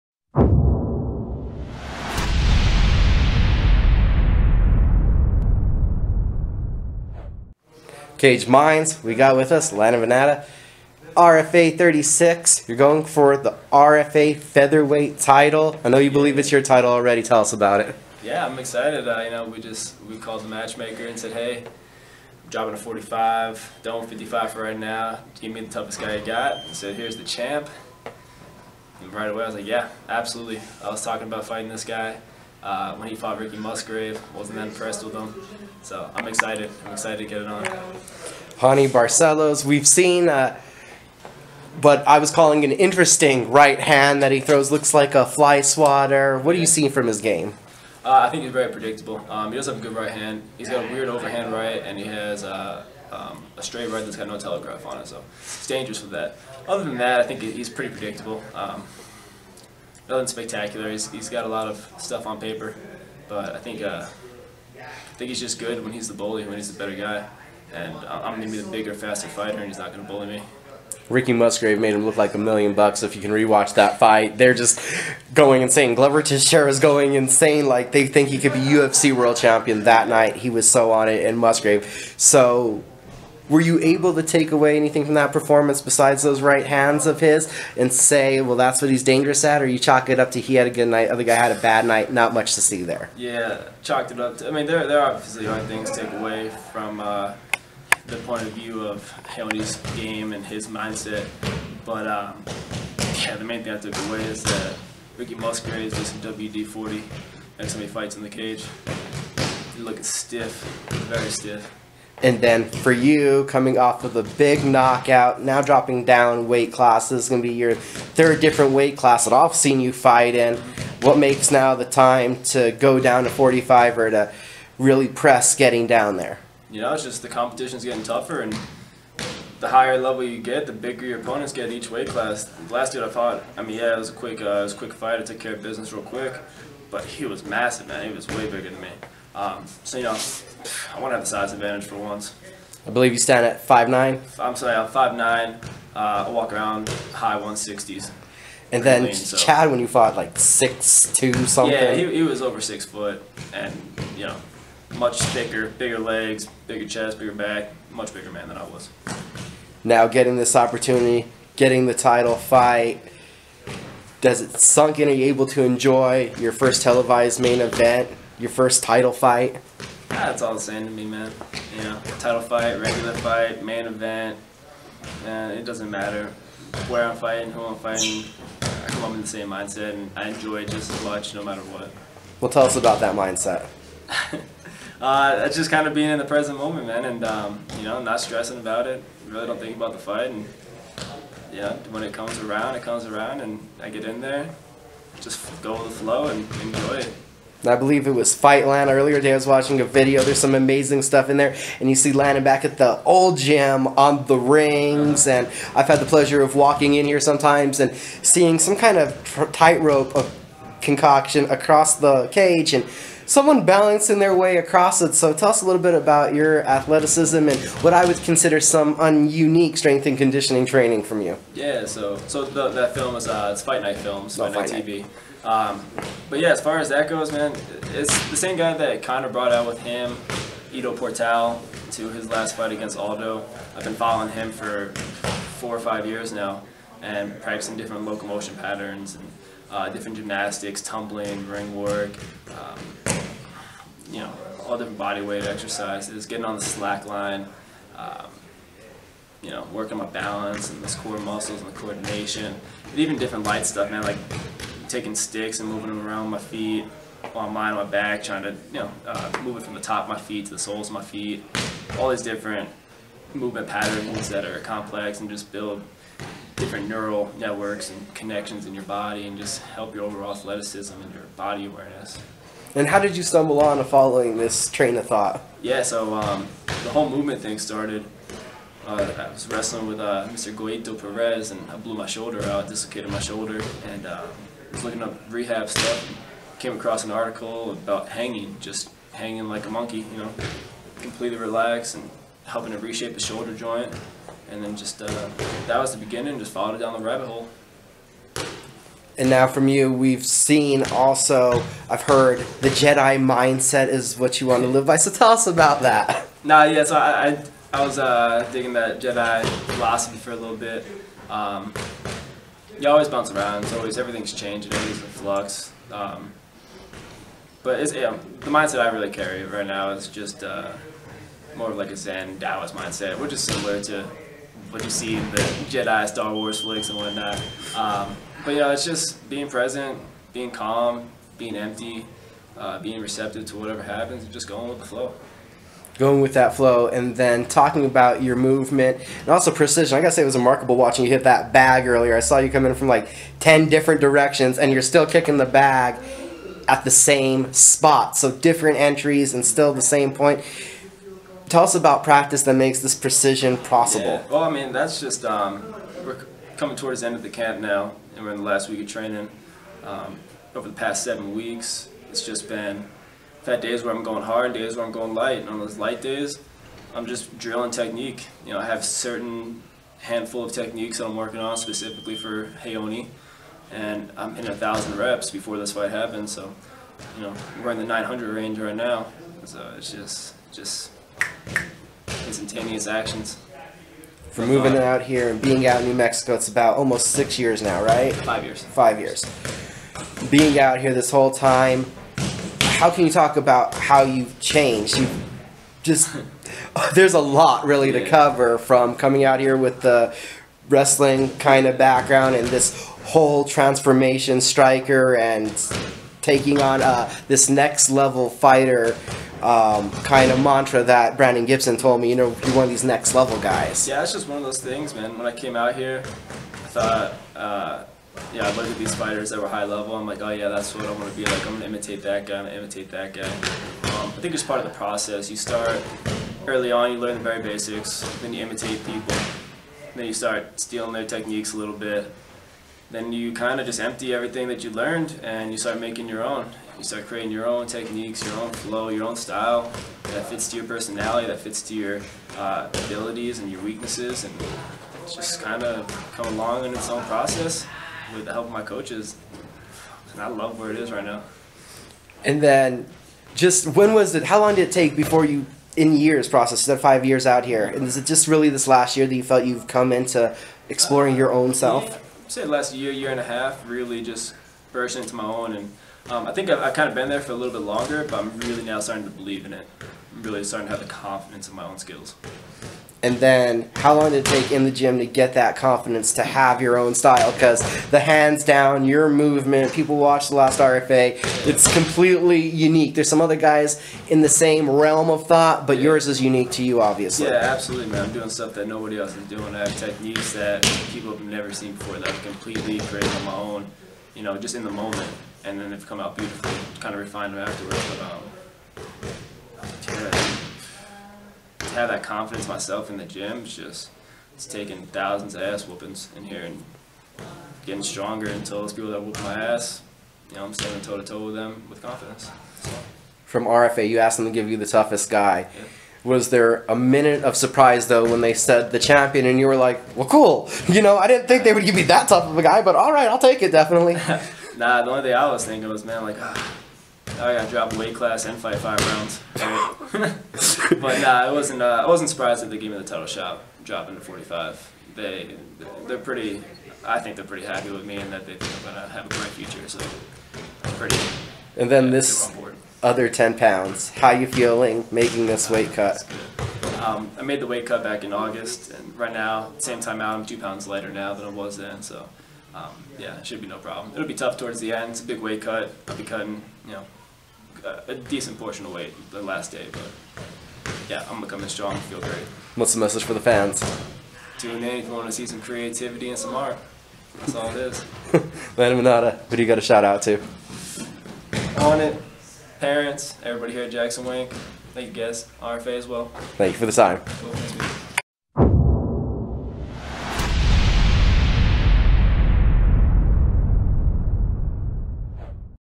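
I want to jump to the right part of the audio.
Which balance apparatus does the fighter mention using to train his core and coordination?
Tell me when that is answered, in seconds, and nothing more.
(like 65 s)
246 s.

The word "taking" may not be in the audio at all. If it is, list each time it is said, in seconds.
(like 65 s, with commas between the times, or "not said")
254 s, 406 s, 504 s.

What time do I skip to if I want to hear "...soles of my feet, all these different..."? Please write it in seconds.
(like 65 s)
260 s.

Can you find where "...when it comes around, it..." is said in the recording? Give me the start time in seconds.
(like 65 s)
191 s.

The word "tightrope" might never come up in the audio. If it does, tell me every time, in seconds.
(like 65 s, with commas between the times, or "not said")
209 s.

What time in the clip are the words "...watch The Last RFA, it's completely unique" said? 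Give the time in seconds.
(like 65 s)
479 s.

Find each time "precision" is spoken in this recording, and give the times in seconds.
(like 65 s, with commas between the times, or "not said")
339 s, 352 s.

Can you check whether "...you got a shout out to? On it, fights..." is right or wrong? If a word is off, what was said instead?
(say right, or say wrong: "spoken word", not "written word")
wrong: "parents", not "fights".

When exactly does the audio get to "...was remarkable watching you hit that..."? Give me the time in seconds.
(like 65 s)
340 s.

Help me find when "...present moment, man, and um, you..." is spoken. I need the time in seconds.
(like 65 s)
186 s.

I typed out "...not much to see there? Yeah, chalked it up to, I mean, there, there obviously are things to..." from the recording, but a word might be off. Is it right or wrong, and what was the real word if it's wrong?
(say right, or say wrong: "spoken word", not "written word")
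right.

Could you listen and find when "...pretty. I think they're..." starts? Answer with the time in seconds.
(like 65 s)
535 s.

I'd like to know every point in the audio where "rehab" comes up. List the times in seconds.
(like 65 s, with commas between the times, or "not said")
285 s.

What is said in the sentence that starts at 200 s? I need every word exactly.
There's some amazing stuff in there, and you see Landon back at the old gym on the rings.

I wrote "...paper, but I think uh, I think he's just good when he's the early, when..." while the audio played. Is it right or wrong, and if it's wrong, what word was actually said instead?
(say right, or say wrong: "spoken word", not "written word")
wrong: "bully", not "early".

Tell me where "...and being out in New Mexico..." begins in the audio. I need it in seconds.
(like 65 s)
385 s.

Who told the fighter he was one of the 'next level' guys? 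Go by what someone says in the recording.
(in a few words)
Brandon Gibson.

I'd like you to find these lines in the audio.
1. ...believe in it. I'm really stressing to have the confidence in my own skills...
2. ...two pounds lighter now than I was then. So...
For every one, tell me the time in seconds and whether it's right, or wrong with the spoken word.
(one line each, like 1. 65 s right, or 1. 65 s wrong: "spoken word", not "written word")
1. 469 s wrong: "starting", not "stressing"
2. 550 s right.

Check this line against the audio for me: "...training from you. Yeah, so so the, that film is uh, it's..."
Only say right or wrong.
right.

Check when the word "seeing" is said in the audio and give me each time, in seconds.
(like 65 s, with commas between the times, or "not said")
46 s, 207 s.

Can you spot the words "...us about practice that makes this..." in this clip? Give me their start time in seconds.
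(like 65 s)
351 s.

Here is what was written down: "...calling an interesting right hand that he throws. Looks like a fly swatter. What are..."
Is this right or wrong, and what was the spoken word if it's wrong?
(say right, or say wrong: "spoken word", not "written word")
right.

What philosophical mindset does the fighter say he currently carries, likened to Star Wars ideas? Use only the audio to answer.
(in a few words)
Zen Taoist.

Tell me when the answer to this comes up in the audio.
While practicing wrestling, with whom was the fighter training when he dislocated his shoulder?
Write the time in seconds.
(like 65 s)
280 s.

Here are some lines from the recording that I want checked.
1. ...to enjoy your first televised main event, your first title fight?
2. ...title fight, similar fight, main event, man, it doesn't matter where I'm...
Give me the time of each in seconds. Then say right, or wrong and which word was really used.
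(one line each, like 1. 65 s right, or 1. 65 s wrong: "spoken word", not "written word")
1. 165 s right
2. 172 s wrong: "regular", not "similar".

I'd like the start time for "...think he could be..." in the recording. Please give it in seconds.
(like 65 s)
78 s.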